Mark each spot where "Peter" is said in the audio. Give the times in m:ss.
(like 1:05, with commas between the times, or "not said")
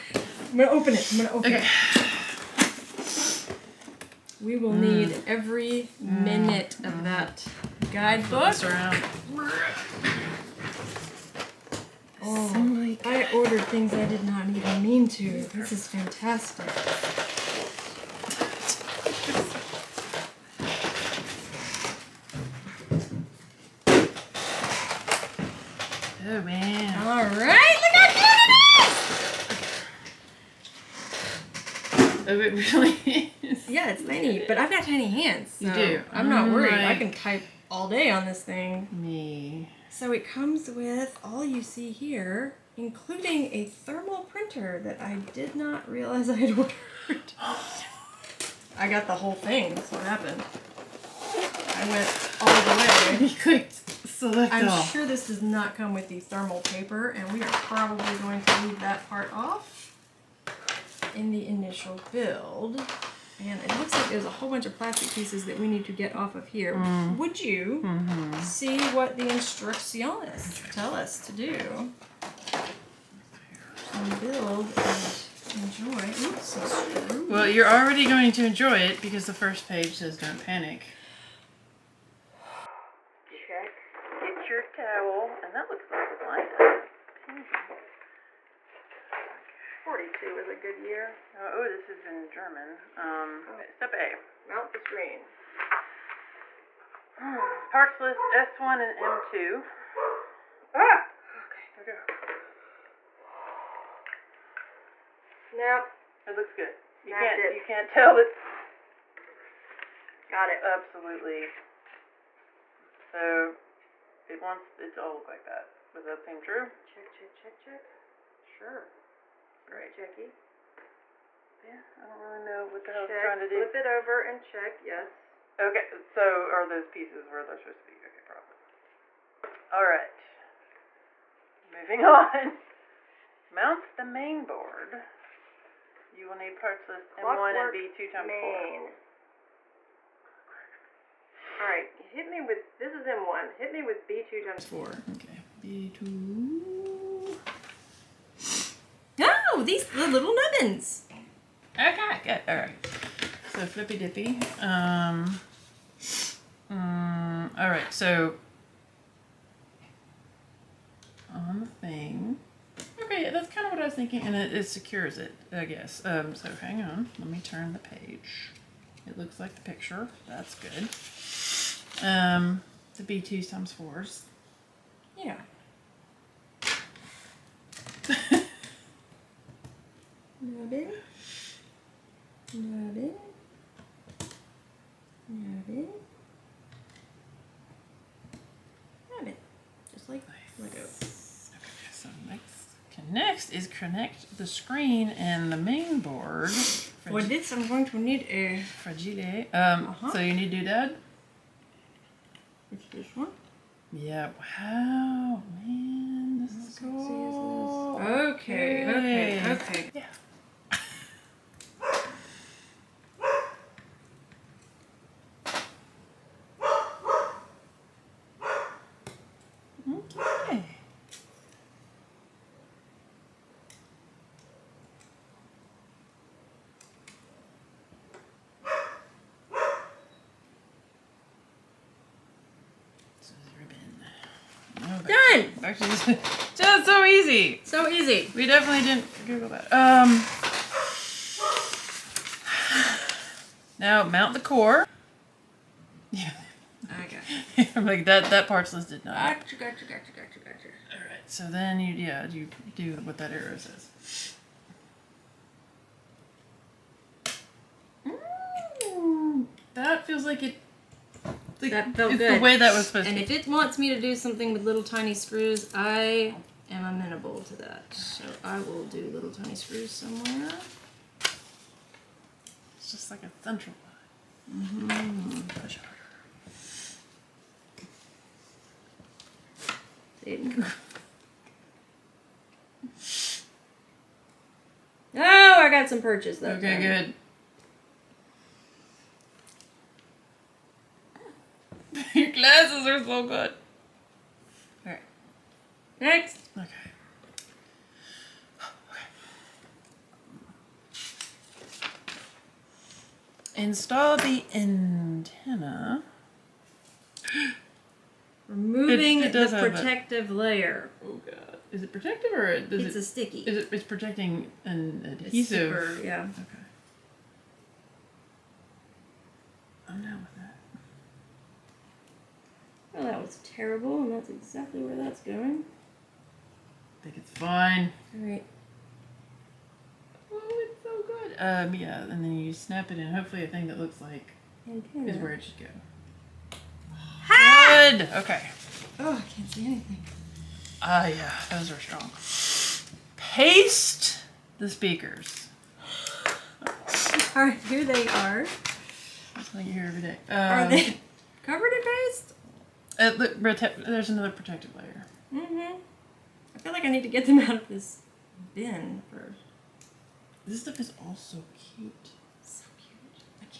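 not said.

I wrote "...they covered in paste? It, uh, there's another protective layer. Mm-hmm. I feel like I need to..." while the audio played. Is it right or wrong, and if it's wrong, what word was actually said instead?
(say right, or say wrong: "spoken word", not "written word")
right.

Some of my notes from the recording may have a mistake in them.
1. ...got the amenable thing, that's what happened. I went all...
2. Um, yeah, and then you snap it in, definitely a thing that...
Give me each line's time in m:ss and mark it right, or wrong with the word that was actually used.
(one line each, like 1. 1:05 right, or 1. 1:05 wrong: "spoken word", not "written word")
1. 0:48 wrong: "whole", not "amenable"
2. 5:31 wrong: "hopefully", not "definitely".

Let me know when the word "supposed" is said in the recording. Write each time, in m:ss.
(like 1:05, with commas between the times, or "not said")
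2:07, 4:22.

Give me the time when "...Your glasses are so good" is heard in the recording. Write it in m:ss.
4:52.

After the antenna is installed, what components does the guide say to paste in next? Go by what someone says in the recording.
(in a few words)
speakers.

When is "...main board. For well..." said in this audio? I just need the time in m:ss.
3:15.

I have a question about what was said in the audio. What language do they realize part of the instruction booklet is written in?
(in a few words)
German.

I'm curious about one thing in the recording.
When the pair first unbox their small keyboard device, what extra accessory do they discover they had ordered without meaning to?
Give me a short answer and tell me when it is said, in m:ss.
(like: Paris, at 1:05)
thermal printer, at 0:43.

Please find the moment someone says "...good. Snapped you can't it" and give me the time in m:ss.
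1:46.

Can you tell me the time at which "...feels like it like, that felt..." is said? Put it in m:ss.
4:20.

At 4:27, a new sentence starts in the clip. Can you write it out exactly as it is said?
So I will do little tiny screws somewhere.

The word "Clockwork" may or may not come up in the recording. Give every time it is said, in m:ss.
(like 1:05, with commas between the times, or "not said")
2:17.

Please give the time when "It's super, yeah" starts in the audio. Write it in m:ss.
5:15.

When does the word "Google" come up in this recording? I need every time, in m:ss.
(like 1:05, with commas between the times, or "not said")
3:59.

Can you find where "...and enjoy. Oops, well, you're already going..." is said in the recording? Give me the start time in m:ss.
1:14.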